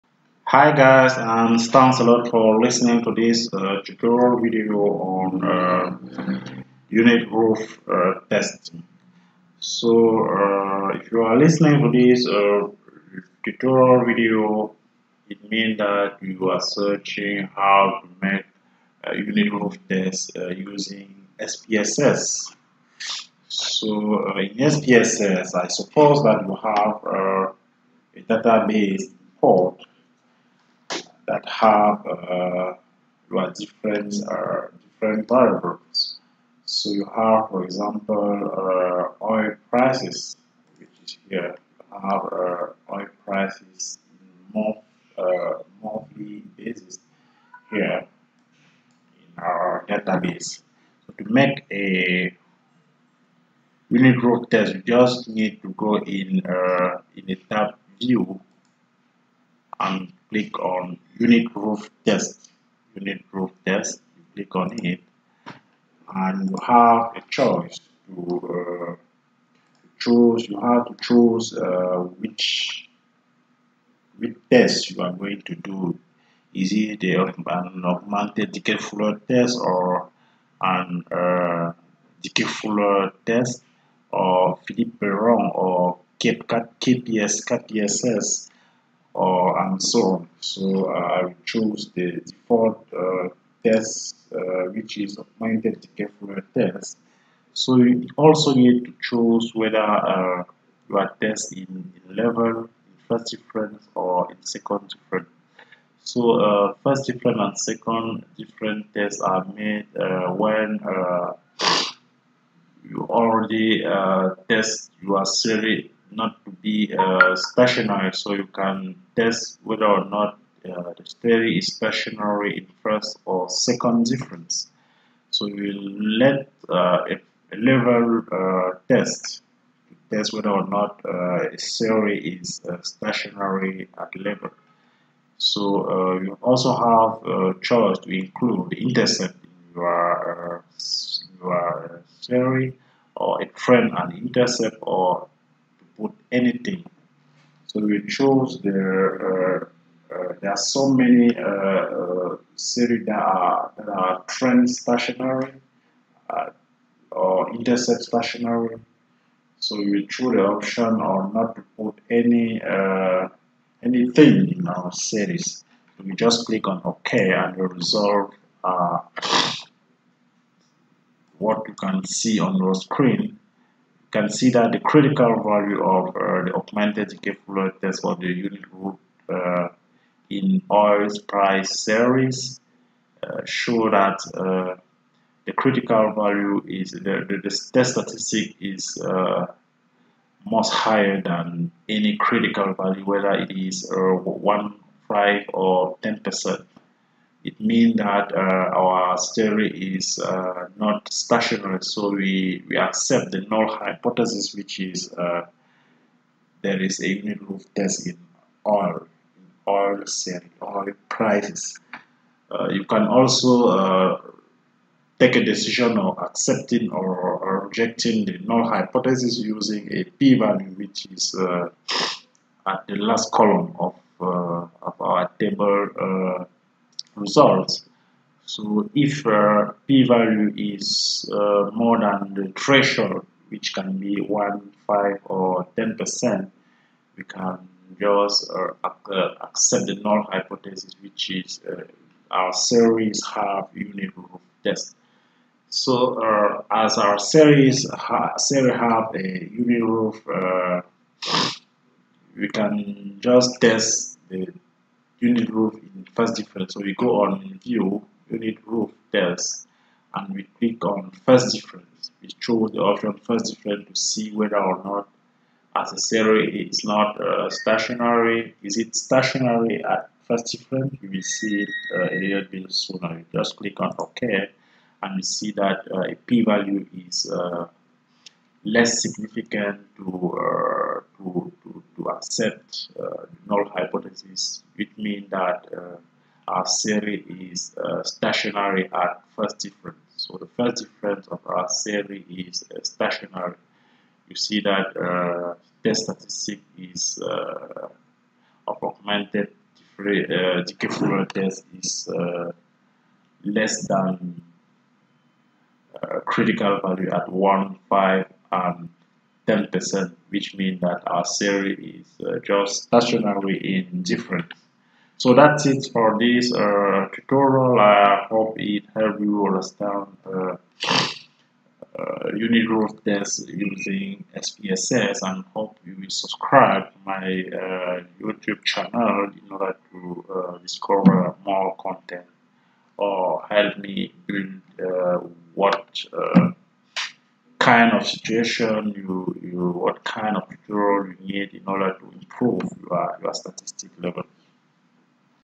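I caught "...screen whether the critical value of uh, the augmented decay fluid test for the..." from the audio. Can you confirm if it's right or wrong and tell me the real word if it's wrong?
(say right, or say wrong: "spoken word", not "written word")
wrong: "consider", not "whether".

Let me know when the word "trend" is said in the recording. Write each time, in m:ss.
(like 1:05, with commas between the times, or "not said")
2:23, 2:34.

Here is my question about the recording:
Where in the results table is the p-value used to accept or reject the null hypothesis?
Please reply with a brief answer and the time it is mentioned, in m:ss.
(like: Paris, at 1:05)
Last column, at 3:43.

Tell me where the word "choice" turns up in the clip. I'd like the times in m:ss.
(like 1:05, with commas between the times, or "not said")
1:07, 2:17.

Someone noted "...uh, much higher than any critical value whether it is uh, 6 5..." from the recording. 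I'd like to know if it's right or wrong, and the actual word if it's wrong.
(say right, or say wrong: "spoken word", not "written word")
wrong: "1", not "6".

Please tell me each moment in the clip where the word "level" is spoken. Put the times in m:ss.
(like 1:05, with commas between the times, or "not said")
1:42, 2:07, 2:14, 5:44.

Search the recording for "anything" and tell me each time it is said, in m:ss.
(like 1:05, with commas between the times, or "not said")
2:26, 2:43.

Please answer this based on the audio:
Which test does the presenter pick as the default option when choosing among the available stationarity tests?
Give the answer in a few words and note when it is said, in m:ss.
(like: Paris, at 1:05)
Augmented Dickey test, at 1:35.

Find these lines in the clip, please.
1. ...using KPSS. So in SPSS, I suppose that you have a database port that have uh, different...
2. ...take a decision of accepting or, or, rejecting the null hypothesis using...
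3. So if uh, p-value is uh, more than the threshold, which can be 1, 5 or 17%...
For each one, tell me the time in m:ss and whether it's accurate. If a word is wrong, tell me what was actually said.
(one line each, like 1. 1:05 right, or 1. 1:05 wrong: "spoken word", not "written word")
1. 0:20 wrong: "SPSS", not "KPSS"
2. 3:35 right
3. 3:48 wrong: "10", not "17".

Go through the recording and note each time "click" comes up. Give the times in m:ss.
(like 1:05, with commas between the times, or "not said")
1:00, 1:04, 2:46, 4:20, 4:33.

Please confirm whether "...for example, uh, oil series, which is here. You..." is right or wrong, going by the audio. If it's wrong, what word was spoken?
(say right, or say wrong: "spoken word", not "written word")
wrong: "prices", not "series".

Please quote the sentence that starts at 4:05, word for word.
So uh, as our series ha series have a unit root, we can just test the unit root in first difference.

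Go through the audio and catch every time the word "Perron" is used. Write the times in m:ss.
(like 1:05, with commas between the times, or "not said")
1:24.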